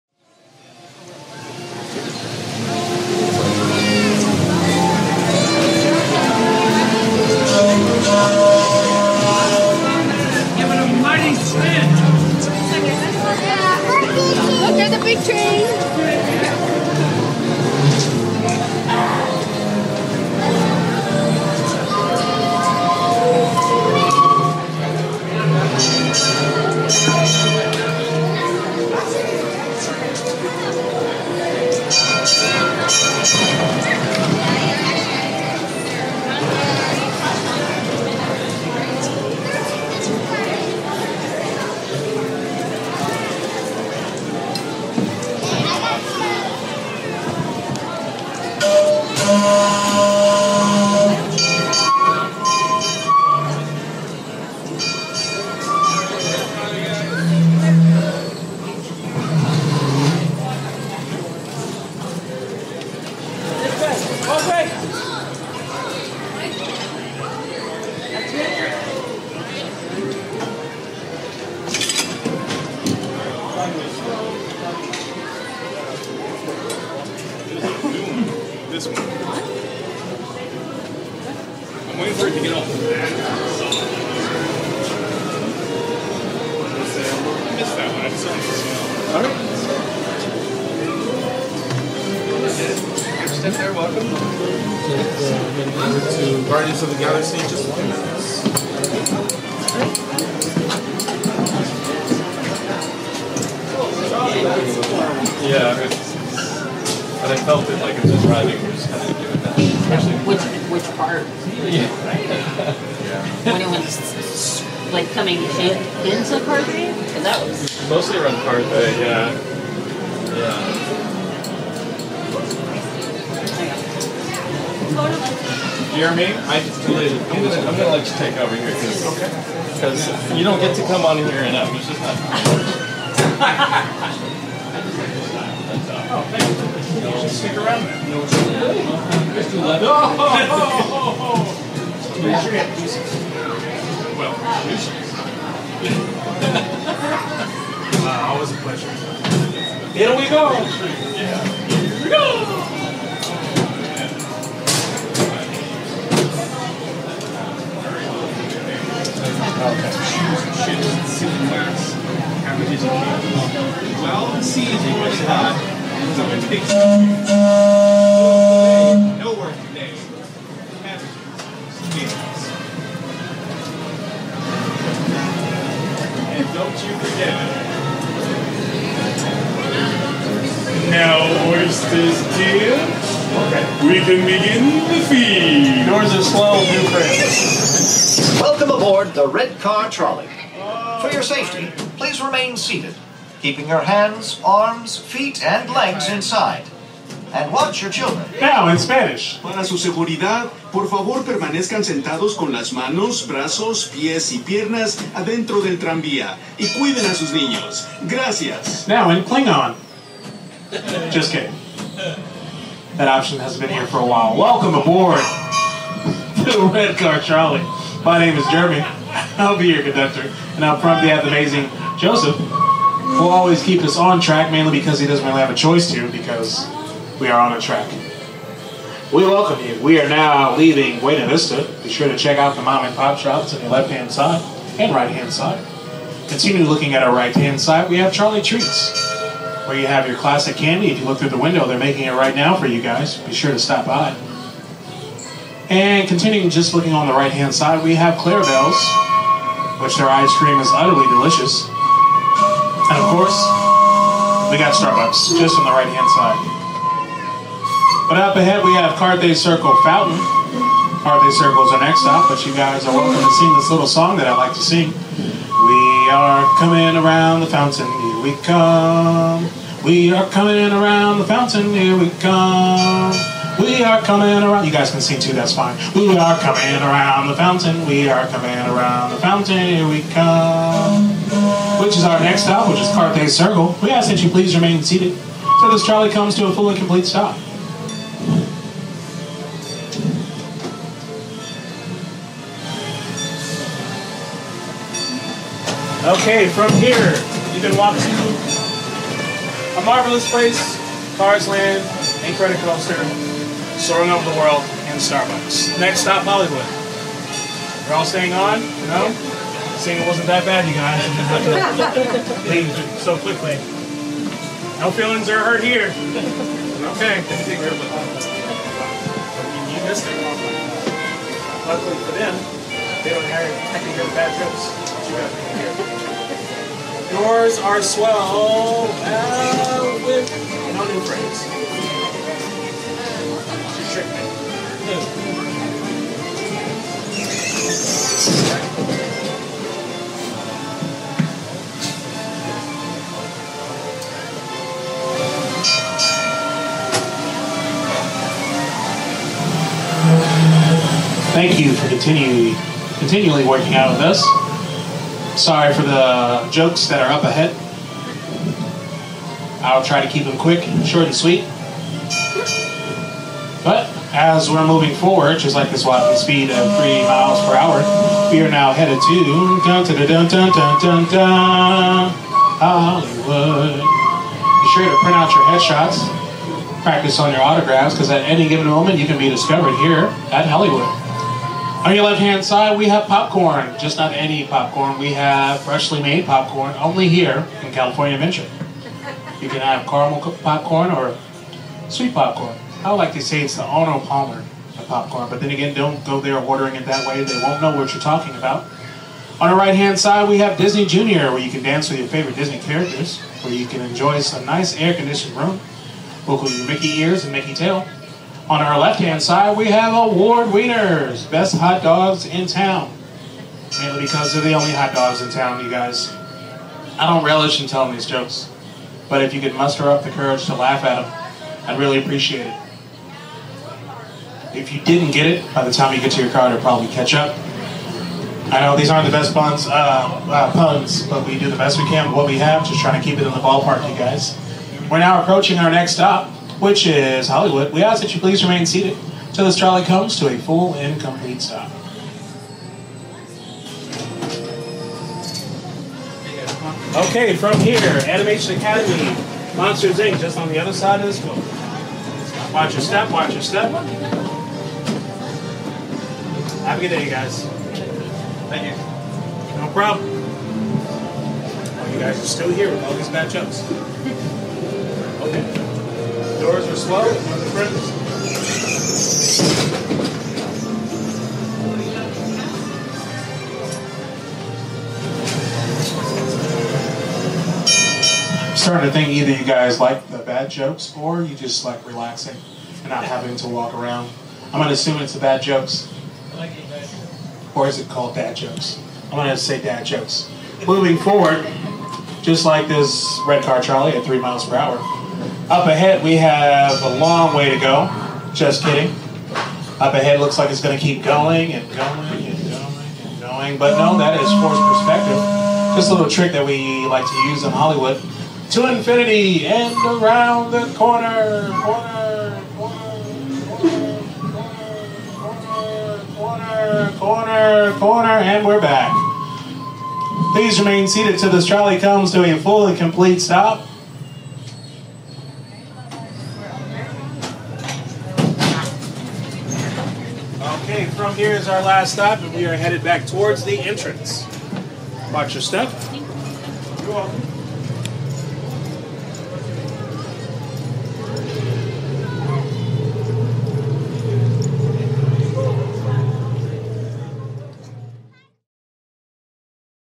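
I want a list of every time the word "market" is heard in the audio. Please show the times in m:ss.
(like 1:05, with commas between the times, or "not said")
not said.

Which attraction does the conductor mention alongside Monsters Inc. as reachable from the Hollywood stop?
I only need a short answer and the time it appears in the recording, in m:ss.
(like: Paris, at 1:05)
Animation Academy, at 7:28.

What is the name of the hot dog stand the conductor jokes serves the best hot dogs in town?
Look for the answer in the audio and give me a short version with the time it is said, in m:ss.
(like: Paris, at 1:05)
Award Wieners, at 6:49.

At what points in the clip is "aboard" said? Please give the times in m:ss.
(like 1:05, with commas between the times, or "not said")
3:08, 3:34.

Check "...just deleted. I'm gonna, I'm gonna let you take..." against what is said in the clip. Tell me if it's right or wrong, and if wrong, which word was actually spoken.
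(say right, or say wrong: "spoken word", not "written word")
right.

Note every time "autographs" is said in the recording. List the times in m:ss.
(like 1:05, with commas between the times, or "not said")
6:17.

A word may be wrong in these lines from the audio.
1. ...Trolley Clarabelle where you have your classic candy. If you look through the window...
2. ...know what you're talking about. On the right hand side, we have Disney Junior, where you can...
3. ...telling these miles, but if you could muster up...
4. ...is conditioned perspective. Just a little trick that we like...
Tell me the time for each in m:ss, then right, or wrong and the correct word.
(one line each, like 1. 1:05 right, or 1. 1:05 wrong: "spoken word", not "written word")
1. 3:58 wrong: "Treats", not "Clarabelle"
2. 6:37 right
3. 6:57 wrong: "jokes", not "miles"
4. 8:24 wrong: "forced", not "conditioned".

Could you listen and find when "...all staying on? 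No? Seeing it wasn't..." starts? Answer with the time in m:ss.
5:07.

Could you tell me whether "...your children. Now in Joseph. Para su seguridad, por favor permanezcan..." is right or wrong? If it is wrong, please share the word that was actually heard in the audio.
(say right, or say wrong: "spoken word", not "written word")
wrong: "Spanish", not "Joseph".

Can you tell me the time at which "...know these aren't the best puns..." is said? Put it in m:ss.
7:08.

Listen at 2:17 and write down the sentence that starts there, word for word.
should stick around No, it's too late.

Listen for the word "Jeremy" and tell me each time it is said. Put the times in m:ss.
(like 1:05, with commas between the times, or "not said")
2:06, 3:38.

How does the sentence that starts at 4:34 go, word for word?
You guys can sing too, that's fine.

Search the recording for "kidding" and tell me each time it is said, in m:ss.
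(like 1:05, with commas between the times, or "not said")
3:31, 8:18.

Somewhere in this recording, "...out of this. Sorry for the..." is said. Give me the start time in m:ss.
5:53.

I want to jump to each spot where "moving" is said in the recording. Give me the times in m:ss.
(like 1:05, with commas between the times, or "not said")
6:04, 8:10.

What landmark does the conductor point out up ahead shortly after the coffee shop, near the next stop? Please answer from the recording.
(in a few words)
Carthay Circle Fountain.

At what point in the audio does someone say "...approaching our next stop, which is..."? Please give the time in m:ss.
7:15.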